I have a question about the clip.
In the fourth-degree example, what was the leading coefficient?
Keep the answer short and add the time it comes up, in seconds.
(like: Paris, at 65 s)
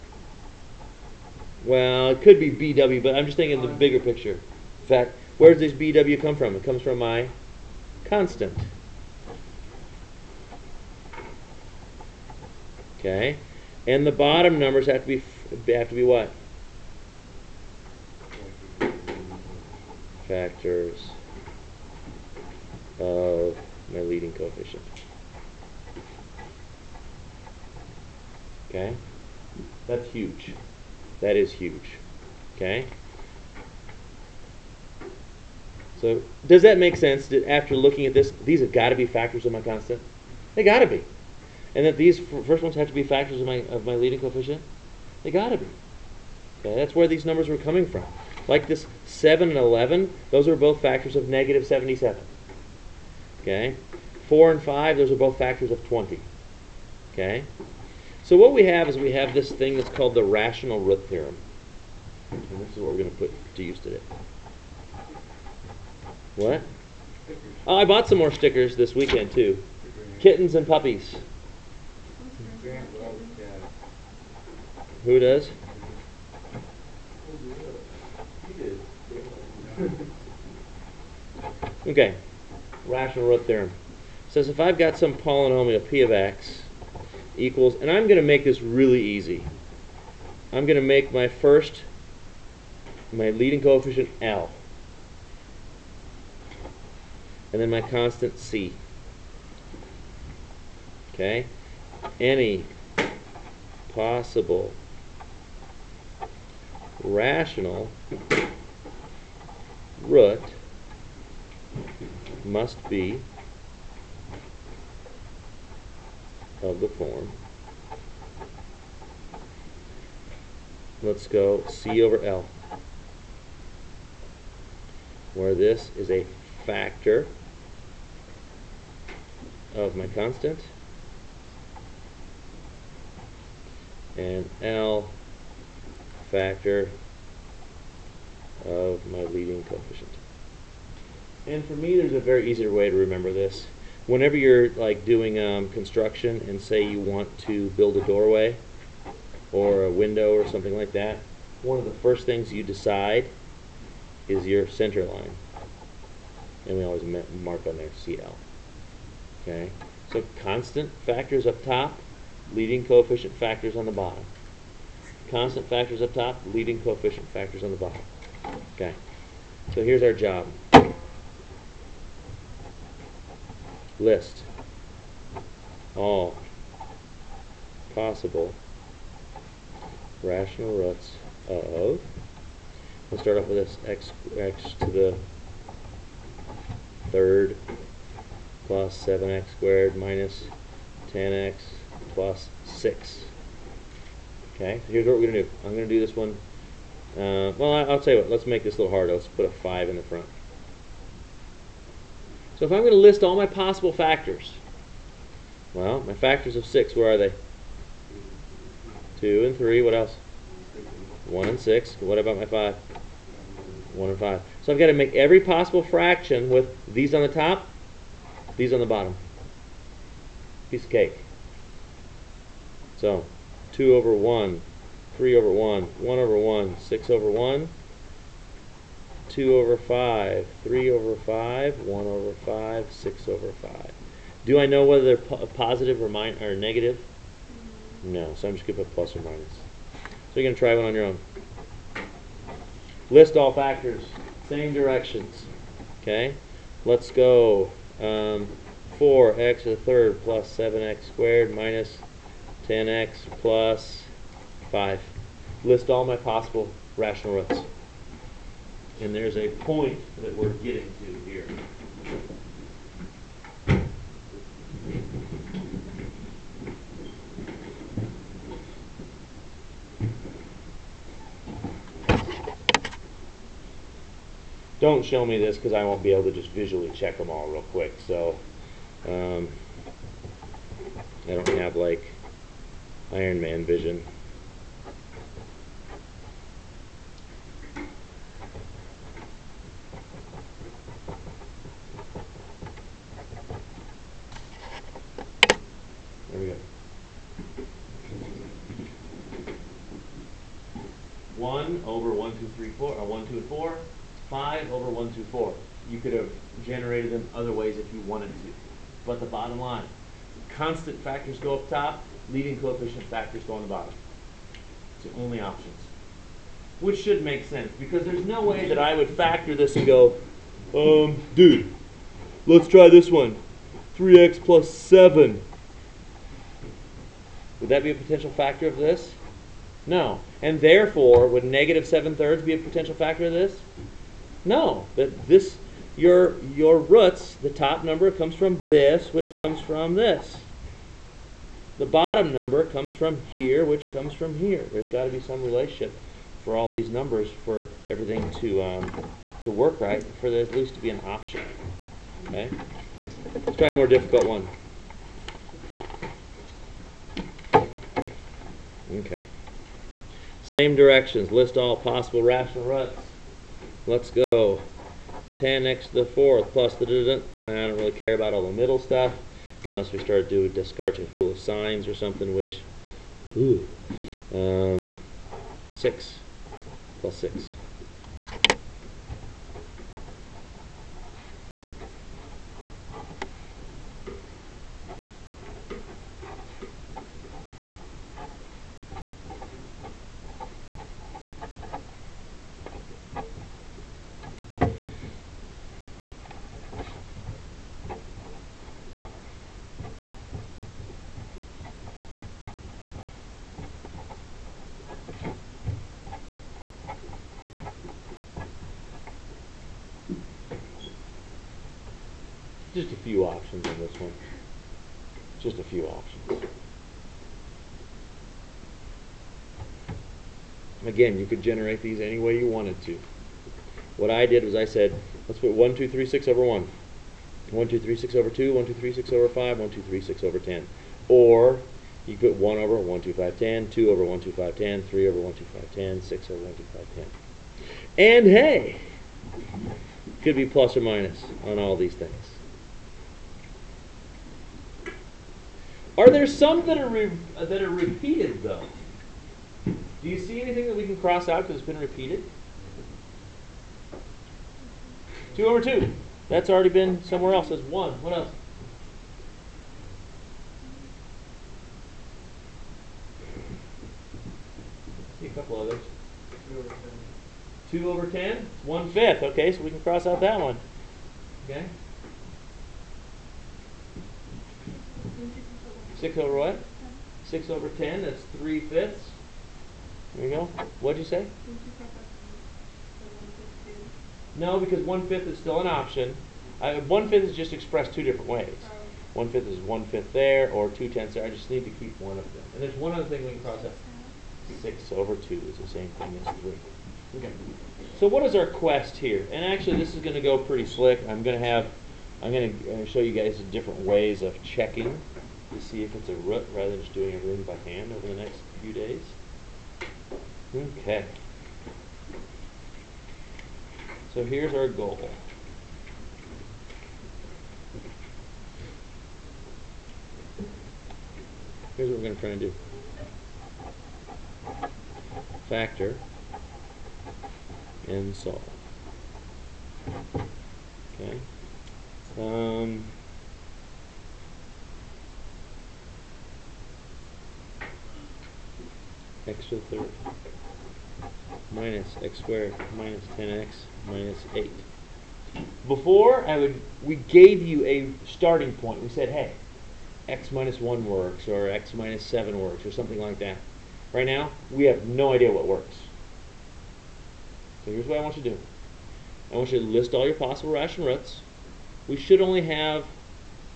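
10, at 365 s.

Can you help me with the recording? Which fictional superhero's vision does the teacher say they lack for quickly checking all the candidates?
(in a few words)
Iron Man.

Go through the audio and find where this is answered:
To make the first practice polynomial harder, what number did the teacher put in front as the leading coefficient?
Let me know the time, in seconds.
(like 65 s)
199 s.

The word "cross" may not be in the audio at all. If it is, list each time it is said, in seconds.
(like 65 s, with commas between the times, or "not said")
450 s, 469 s, 493 s.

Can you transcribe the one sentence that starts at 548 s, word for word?
We said, hey, x minus 1 works or x minus 7 works or something like that.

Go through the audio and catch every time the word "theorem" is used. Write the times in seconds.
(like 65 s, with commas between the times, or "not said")
61 s, 83 s.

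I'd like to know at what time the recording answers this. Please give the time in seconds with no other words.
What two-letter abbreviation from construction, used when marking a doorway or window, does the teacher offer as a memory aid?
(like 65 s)
157 s.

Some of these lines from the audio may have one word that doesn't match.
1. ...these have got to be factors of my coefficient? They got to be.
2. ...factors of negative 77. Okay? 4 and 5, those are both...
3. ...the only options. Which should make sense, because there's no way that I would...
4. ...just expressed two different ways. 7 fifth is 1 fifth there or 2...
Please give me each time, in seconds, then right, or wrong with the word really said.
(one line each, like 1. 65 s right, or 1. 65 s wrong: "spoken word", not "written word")
1. 38 s wrong: "constant", not "coefficient"
2. 50 s right
3. 315 s right
4. 487 s wrong: "1", not "7".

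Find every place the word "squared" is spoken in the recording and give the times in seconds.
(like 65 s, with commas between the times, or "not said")
189 s, 251 s, 542 s.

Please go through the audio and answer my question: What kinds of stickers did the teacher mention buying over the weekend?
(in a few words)
Kittens and puppies.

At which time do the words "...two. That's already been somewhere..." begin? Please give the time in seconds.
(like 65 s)
455 s.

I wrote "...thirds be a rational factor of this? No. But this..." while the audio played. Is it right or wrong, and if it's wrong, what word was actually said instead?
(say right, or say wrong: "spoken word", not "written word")
wrong: "potential", not "rational".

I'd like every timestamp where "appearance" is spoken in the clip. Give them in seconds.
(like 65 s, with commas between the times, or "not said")
not said.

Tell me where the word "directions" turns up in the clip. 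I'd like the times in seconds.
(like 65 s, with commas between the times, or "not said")
244 s, 360 s.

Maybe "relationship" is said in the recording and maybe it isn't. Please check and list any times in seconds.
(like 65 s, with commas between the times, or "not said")
345 s.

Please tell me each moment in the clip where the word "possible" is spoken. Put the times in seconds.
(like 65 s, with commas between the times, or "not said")
103 s, 177 s, 203 s, 215 s, 256 s, 361 s, 560 s.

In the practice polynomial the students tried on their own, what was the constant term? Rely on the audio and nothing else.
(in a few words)
5.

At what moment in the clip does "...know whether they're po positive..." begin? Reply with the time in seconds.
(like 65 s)
234 s.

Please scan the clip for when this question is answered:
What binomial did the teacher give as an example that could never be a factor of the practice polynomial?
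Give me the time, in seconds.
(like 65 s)
323 s.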